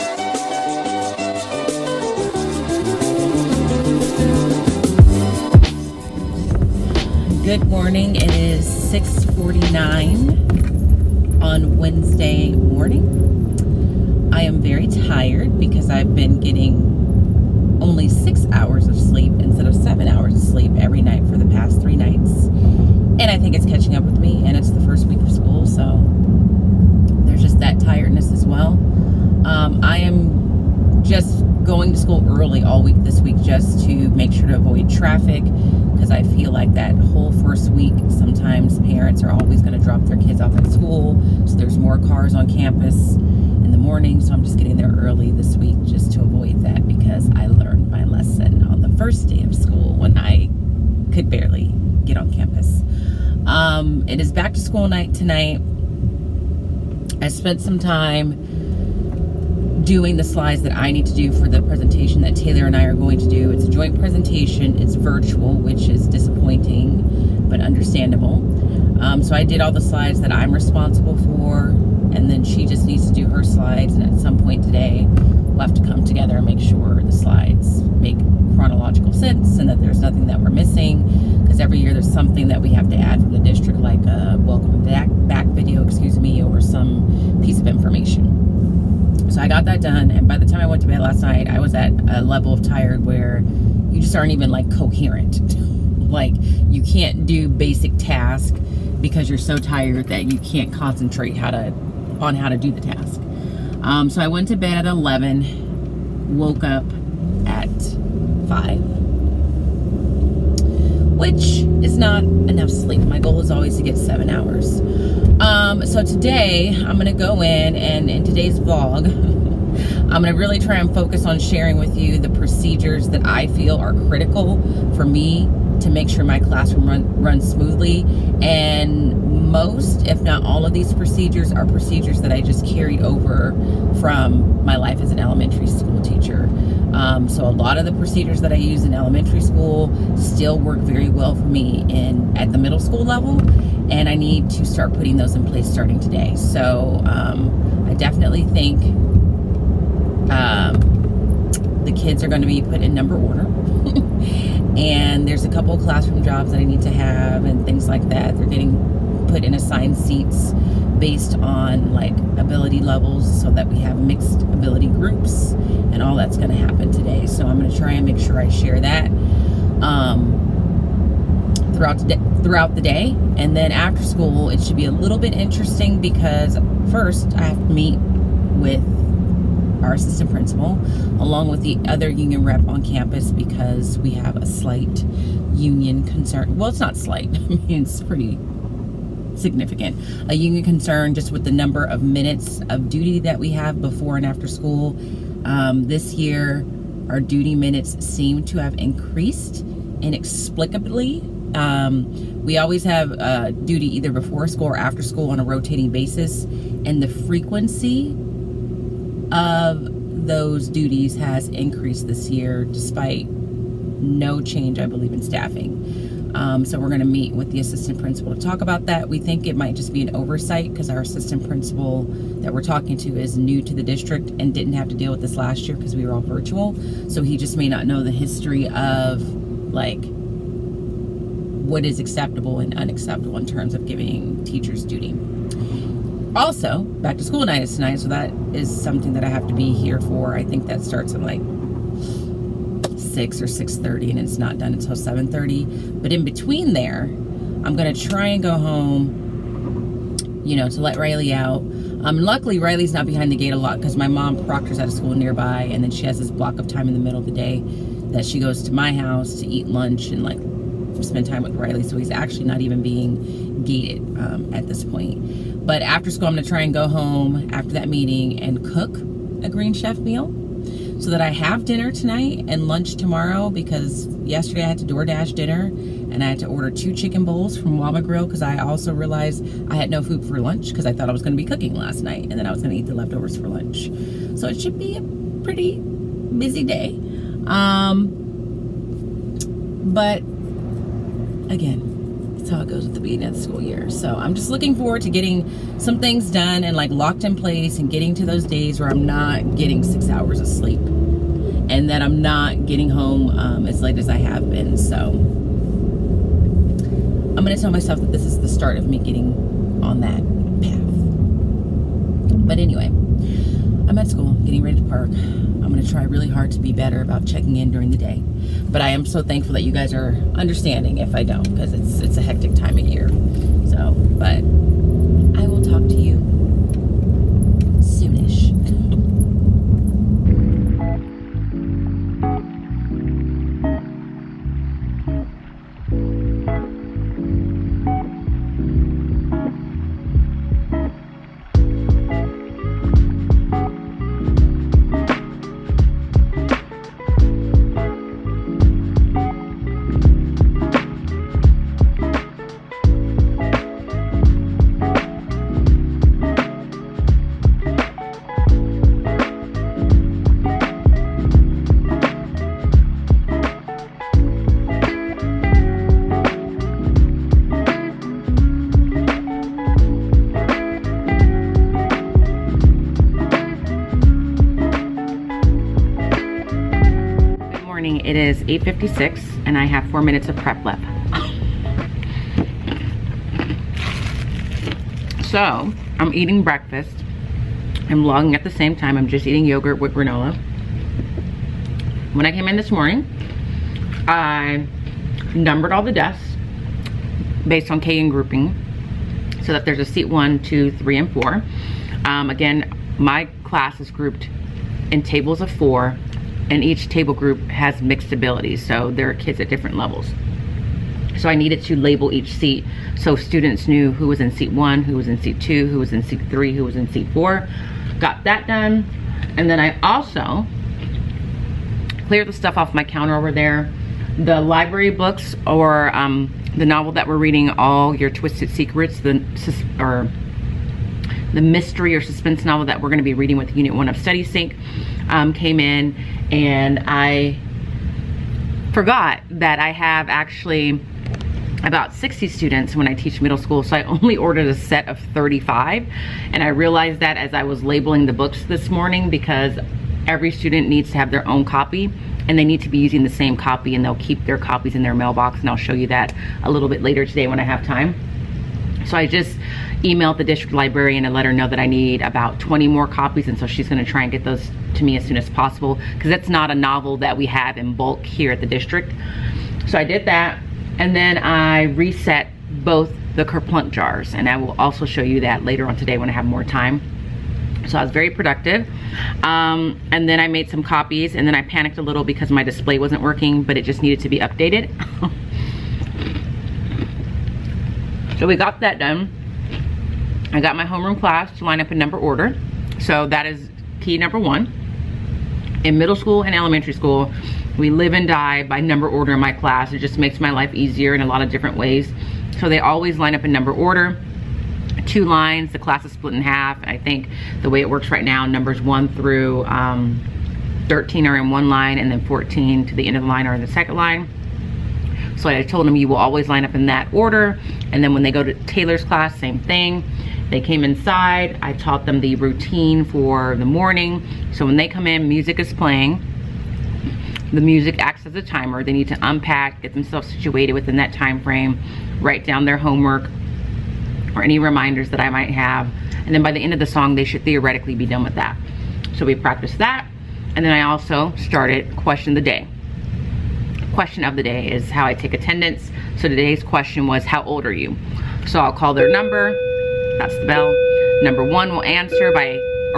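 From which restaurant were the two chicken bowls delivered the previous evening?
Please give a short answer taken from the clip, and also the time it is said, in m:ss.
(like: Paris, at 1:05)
Waba Grill, at 4:37.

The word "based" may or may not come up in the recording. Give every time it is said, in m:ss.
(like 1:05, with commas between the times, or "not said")
2:40, 6:37.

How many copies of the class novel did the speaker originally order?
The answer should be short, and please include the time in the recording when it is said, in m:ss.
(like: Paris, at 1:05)
35, at 7:25.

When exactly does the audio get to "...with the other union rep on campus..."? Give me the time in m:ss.
3:01.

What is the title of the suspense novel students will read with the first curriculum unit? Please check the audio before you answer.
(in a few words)
All Your Twisted Secrets.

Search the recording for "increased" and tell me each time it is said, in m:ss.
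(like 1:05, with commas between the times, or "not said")
3:18, 3:31.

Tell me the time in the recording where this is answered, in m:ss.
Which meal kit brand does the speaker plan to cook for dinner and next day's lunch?
4:29.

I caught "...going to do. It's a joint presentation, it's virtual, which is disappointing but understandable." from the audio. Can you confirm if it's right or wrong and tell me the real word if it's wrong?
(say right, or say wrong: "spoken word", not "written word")
right.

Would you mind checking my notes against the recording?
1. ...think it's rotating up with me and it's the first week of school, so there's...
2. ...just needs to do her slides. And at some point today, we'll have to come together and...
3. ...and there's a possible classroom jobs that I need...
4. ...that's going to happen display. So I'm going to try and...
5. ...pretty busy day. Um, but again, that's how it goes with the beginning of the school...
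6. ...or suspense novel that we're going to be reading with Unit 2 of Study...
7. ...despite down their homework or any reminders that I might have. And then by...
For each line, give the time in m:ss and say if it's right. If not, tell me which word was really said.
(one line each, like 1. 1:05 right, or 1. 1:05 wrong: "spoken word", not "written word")
1. 0:23 wrong: "catching", not "rotating"
2. 1:12 right
3. 2:34 wrong: "couple", not "possible"
4. 2:46 wrong: "today", not "display"
5. 4:45 right
6. 7:11 wrong: "1", not "2"
7. 8:52 wrong: "write", not "despite".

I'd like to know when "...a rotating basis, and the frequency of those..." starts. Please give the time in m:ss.
3:25.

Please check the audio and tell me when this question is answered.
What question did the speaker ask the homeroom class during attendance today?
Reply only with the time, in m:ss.
9:07.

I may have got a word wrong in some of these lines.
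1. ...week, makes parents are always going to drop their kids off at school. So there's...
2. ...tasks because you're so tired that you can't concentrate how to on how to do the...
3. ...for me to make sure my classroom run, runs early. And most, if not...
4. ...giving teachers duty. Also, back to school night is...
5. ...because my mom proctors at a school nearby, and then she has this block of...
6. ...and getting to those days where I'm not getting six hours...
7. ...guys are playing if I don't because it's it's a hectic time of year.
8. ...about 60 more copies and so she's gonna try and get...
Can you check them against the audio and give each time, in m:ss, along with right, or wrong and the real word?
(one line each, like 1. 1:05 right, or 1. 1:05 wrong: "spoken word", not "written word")
1. 0:37 wrong: "sometimes", not "makes"
2. 1:37 right
3. 2:04 wrong: "smoothly", not "early"
4. 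3:53 right
5. 4:13 right
6. 4:57 right
7. 5:19 wrong: "understanding", not "playing"
8. 7:42 wrong: "20", not "60".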